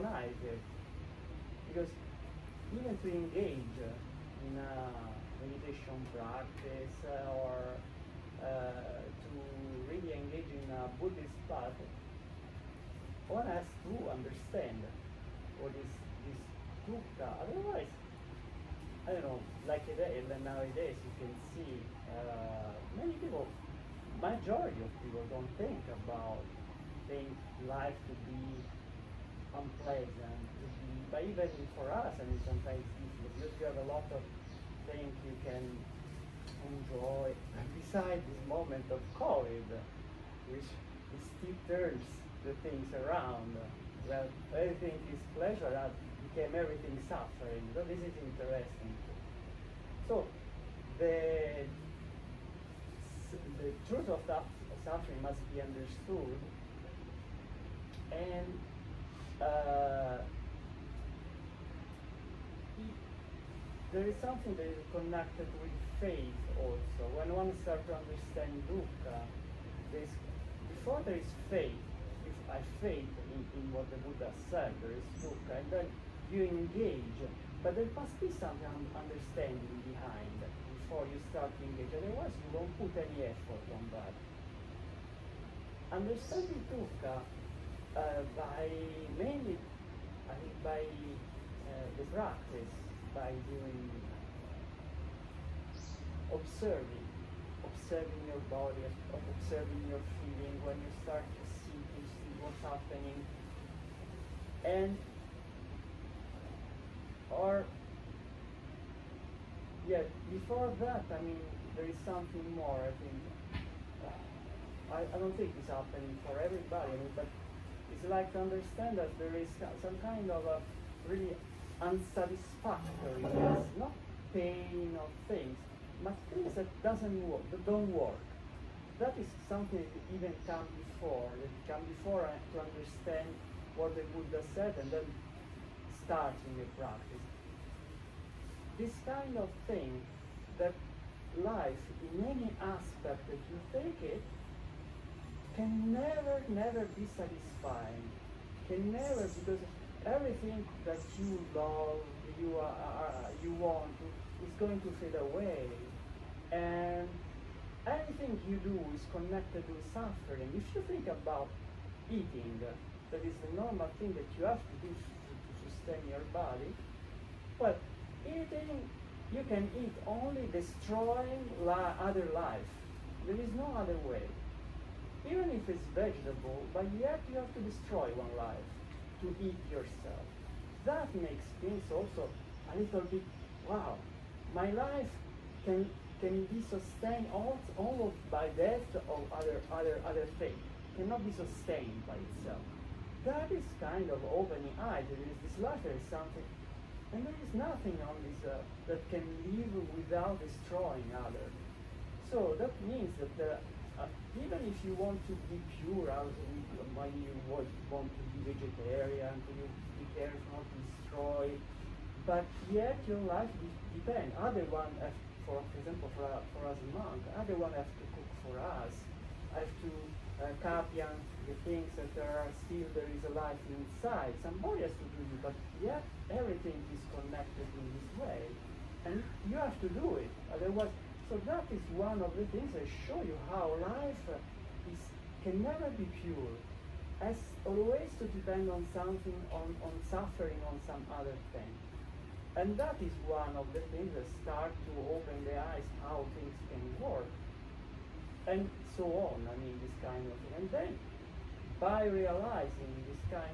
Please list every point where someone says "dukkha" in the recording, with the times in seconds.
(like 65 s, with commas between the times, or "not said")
16 s, 68 s, 75 s, 86 s.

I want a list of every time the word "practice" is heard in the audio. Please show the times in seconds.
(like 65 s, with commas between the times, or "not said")
6 s, 92 s, 136 s.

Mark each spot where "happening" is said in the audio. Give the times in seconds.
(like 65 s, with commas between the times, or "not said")
102 s, 115 s.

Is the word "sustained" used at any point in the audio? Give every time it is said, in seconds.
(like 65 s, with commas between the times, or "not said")
186 s, 191 s.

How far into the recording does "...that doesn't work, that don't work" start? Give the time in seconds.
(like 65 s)
126 s.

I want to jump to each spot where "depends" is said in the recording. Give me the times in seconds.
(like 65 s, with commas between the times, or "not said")
213 s, 238 s.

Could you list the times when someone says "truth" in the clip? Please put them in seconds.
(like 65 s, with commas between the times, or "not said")
53 s.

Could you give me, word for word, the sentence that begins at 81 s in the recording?
Otherwise, you won't put any effort on that.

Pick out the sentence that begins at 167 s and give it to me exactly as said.
But eating, you can eat only destroying li other life.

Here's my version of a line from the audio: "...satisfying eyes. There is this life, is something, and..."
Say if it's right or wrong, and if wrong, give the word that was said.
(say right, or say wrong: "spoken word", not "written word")
wrong: "opening", not "satisfying".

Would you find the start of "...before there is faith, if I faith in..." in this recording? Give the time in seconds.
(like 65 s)
70 s.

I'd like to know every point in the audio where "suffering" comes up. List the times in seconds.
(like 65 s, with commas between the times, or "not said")
47 s, 54 s, 159 s, 240 s.